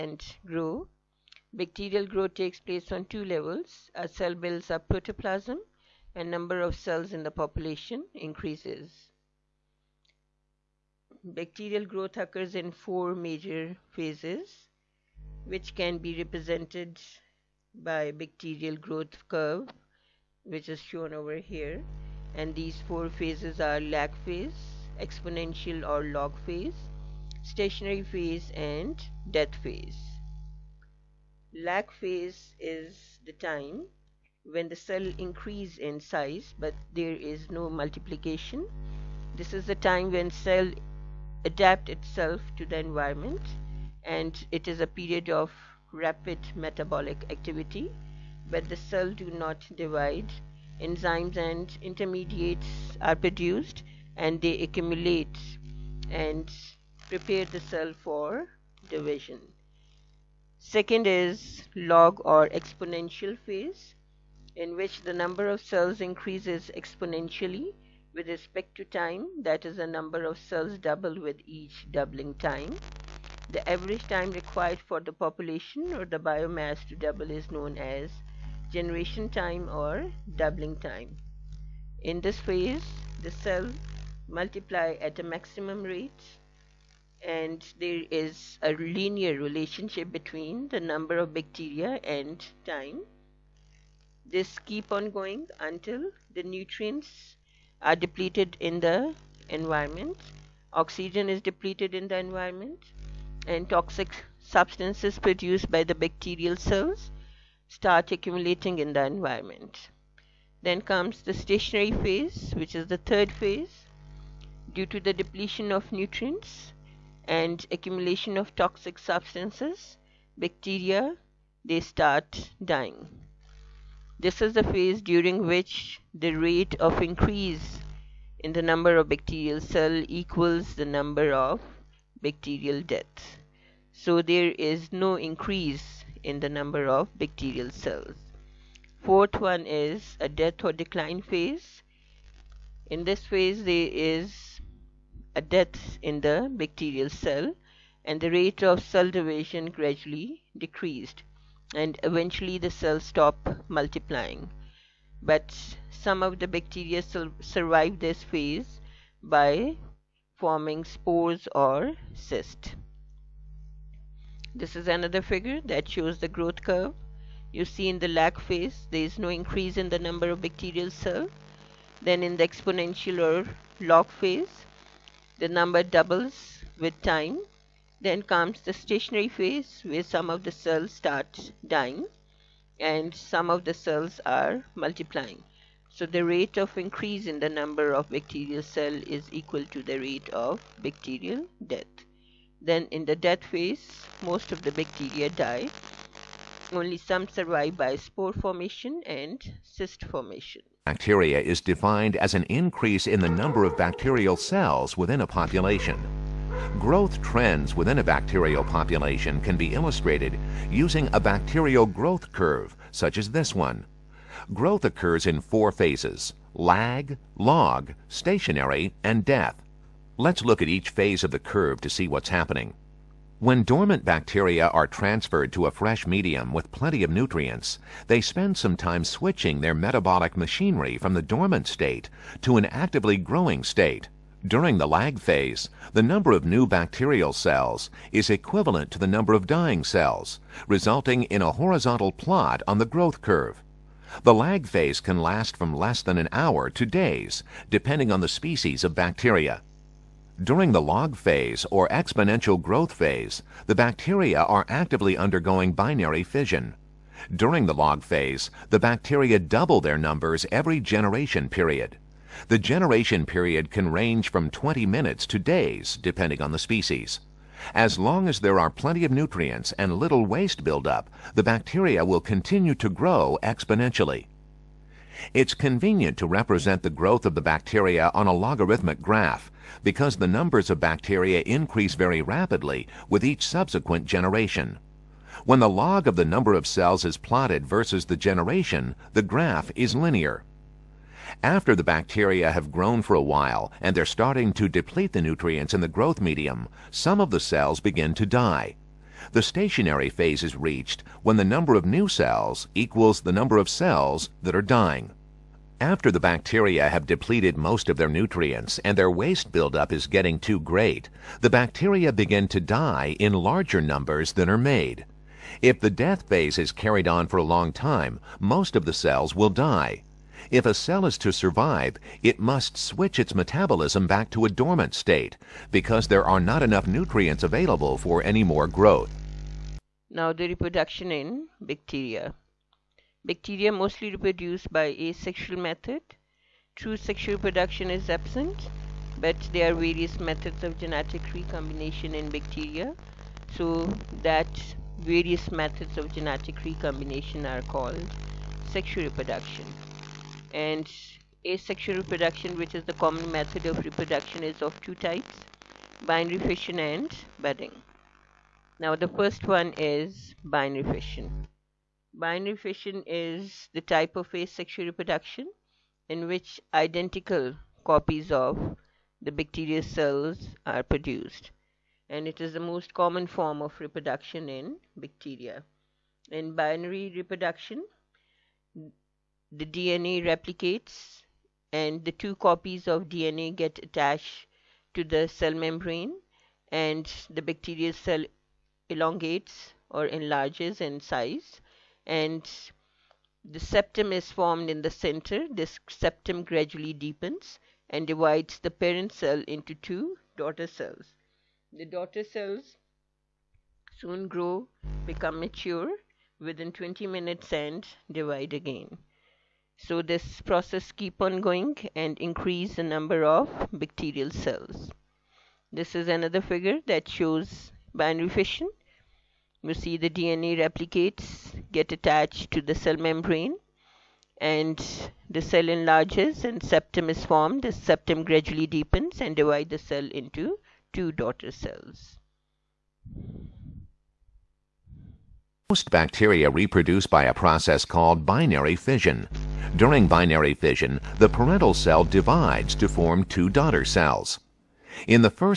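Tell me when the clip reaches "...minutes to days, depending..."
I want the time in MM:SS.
04:24.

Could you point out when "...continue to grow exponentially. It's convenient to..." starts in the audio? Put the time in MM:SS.
04:32.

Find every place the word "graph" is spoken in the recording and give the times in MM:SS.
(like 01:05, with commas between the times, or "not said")
04:39, 04:49.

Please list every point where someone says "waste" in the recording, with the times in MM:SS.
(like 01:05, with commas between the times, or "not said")
04:30, 05:09.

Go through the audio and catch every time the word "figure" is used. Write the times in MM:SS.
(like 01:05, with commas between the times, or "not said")
02:45, 06:56.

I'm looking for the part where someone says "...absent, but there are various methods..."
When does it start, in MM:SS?
05:38.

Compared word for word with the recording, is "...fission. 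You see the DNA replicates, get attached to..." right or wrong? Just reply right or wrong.
right.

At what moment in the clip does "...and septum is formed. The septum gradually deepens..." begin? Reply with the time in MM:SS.
07:06.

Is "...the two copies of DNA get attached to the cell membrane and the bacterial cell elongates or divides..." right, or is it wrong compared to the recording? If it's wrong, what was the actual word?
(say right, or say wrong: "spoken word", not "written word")
wrong: "enlarges", not "divides".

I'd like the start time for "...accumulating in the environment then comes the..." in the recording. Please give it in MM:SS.
01:48.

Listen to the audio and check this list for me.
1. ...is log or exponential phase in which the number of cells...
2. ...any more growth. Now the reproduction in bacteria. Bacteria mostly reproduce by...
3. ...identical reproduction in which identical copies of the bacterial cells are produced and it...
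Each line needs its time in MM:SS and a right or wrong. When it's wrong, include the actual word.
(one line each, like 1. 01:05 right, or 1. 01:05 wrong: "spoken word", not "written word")
1. 01:01 right
2. 05:28 right
3. 06:04 wrong: "asexual", not "identical".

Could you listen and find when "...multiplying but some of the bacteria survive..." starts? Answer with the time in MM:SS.
02:33.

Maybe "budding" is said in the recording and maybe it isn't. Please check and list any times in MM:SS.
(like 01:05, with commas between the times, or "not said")
05:57.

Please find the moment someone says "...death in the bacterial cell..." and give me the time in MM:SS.
02:25.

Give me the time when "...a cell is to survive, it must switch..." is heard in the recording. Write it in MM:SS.
05:20.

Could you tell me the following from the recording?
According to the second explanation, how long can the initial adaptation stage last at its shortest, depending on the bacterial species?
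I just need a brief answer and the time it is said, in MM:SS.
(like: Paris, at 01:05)
Less than an hour, at 04:05.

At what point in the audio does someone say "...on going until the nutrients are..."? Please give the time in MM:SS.
01:34.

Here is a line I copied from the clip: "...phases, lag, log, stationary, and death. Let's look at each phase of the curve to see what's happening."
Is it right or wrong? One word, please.
right.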